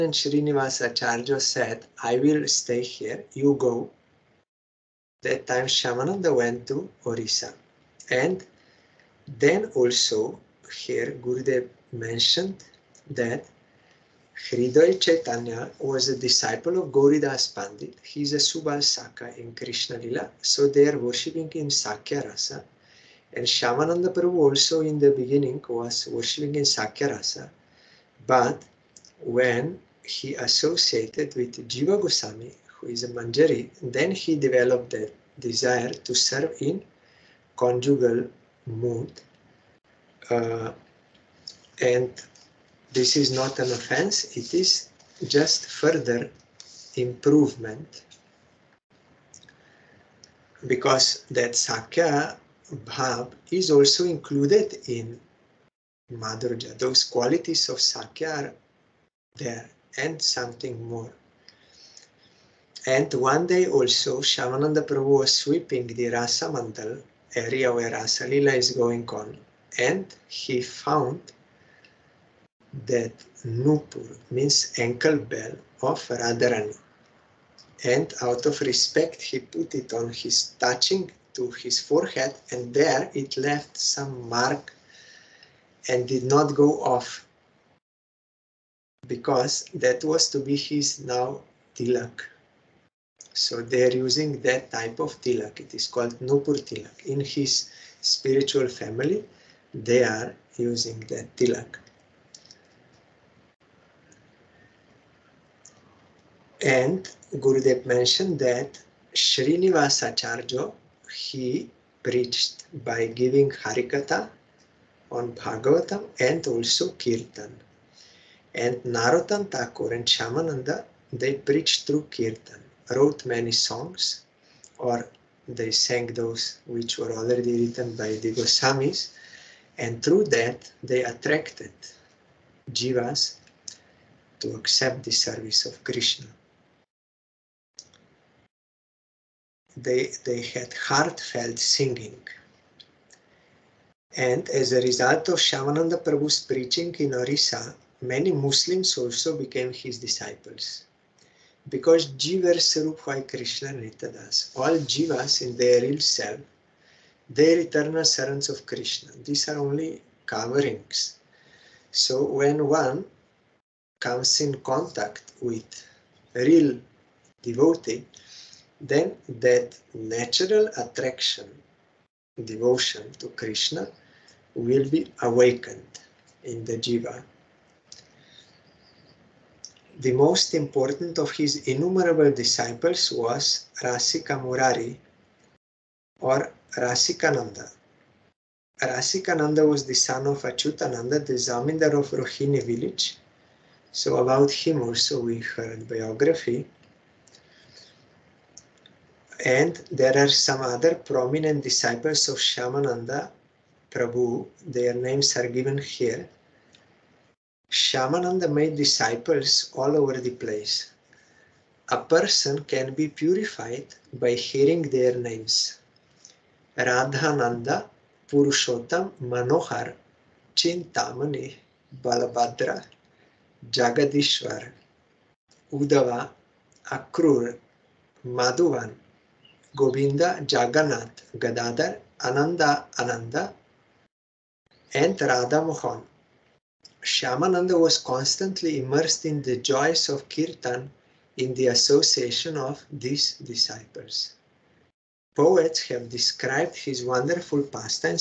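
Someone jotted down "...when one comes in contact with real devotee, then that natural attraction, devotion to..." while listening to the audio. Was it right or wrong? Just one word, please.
right.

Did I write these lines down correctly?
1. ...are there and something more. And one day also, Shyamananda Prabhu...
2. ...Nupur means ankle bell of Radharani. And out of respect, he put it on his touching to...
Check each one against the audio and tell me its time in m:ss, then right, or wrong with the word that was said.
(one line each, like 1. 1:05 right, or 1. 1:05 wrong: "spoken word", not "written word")
1. 0:58 right
2. 1:13 right.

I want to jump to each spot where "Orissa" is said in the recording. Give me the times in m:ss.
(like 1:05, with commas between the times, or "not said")
0:07, 2:27.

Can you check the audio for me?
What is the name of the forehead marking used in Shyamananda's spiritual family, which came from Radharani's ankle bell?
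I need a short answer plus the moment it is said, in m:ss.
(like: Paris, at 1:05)
Nupur tilak, at 1:36.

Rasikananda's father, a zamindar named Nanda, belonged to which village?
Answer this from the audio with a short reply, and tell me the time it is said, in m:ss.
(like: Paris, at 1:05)
Rohini, at 3:12.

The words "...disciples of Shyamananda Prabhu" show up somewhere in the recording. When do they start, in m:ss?
3:21.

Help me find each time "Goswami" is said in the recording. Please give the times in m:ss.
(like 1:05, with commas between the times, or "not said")
0:32, 2:08.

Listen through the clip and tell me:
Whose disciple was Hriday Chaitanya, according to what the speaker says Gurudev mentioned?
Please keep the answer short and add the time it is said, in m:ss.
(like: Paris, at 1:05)
Gauridas Pandit, at 0:16.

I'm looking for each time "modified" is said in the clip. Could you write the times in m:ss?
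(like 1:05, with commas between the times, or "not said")
not said.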